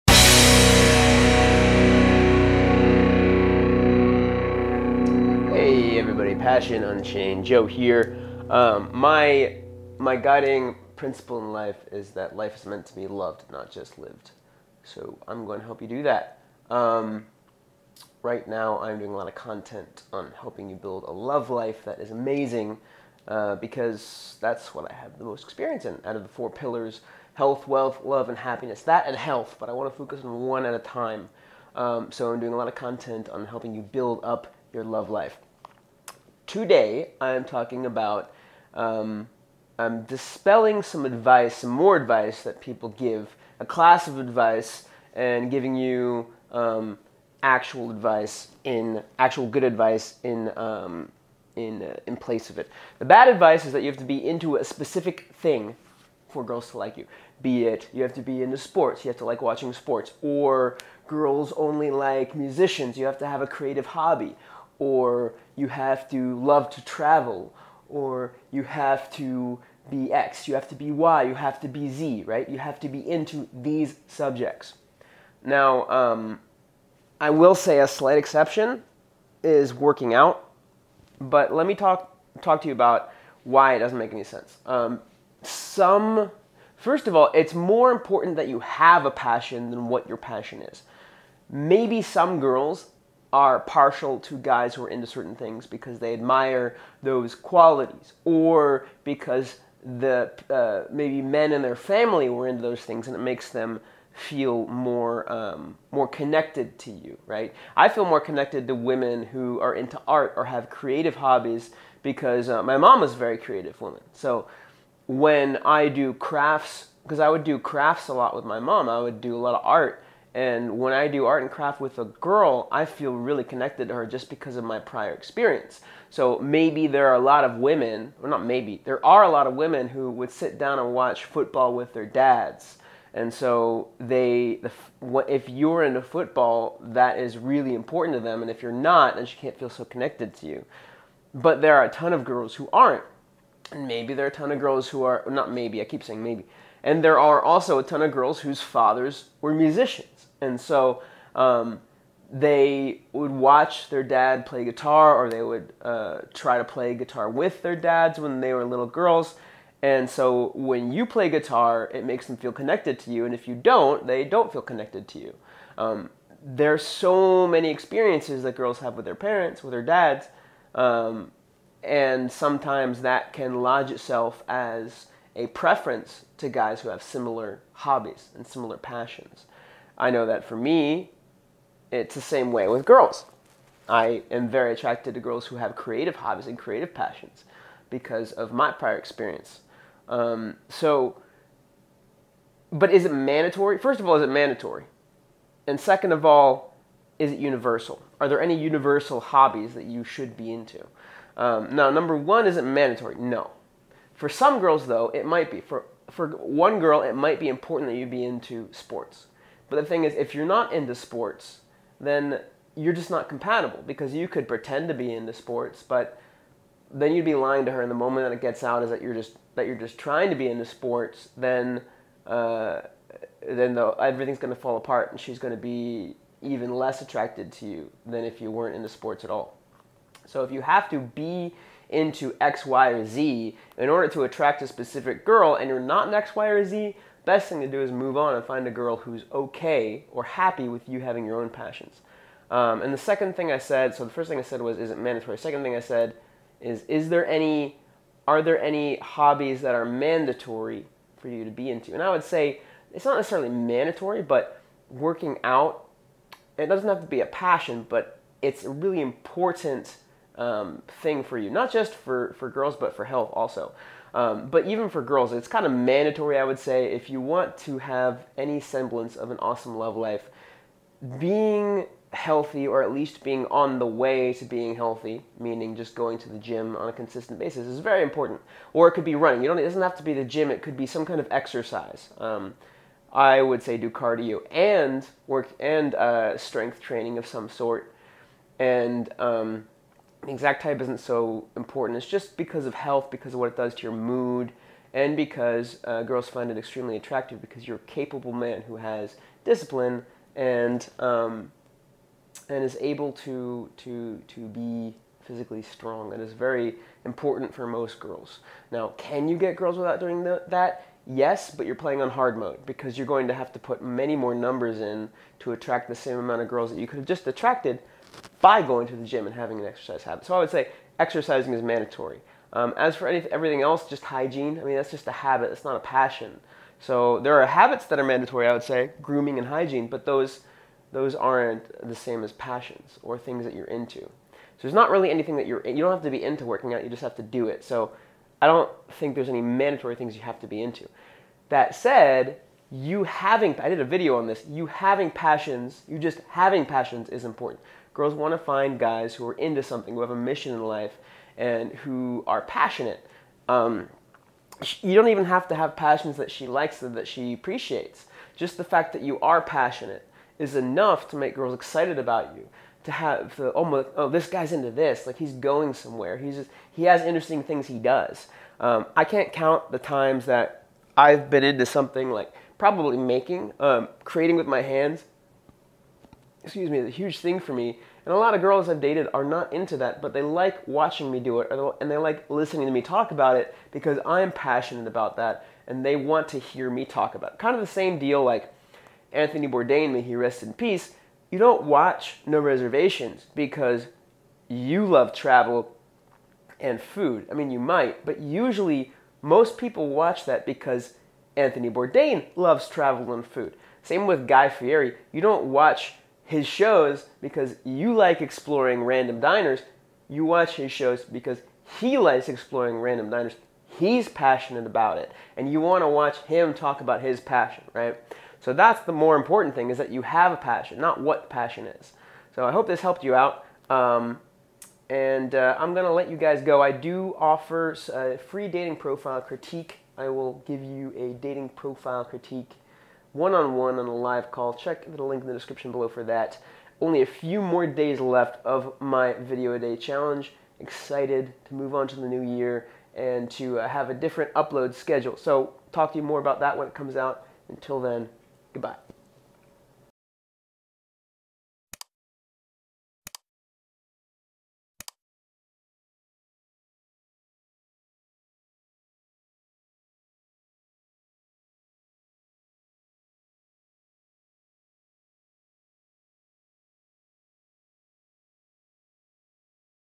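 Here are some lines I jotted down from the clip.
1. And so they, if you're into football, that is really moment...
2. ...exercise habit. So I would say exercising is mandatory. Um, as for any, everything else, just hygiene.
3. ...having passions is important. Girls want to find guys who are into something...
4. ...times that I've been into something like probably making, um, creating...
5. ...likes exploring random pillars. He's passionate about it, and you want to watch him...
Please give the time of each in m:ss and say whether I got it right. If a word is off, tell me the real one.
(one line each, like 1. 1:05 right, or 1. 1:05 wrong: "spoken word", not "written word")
1. 2:13 wrong: "important", not "moment"
2. 5:19 right
3. 5:46 right
4. 6:09 right
5. 6:51 wrong: "diners", not "pillars".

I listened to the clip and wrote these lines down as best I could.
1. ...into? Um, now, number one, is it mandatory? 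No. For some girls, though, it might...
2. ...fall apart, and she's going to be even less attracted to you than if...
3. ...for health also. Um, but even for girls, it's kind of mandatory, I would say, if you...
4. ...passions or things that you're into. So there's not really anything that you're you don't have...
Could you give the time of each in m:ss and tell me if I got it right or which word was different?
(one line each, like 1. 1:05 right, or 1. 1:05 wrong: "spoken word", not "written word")
1. 3:20 right
2. 3:44 right
3. 4:22 right
4. 5:32 right.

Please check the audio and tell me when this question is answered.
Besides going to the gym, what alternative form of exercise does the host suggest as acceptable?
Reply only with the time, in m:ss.
4:39.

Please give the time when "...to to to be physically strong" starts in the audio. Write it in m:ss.
5:03.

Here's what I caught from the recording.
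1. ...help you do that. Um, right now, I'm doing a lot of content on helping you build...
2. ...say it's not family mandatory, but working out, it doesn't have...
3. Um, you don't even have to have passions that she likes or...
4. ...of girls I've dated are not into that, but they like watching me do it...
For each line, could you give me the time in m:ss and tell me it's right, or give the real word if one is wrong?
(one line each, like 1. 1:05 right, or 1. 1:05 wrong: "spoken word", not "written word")
1. 0:15 right
2. 4:12 wrong: "necessarily", not "family"
3. 5:53 right
4. 6:18 right.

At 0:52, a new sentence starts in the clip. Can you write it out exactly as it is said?
The bad advice is that you have to be into a specific thing for girls to like you.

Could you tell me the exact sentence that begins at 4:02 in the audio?
Um, and the second thing I said, so the first thing I said was, is it mandatory?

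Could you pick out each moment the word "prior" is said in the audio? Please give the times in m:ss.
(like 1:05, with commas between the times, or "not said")
2:04, 3:08.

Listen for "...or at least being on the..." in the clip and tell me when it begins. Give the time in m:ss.
4:32.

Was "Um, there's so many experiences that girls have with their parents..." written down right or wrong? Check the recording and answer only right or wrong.
right.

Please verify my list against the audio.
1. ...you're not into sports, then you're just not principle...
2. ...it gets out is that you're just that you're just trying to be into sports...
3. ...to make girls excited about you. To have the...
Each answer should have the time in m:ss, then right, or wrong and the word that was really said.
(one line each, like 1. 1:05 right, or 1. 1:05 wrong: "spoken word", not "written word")
1. 3:30 wrong: "compatible", not "principle"
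2. 3:38 right
3. 6:01 right.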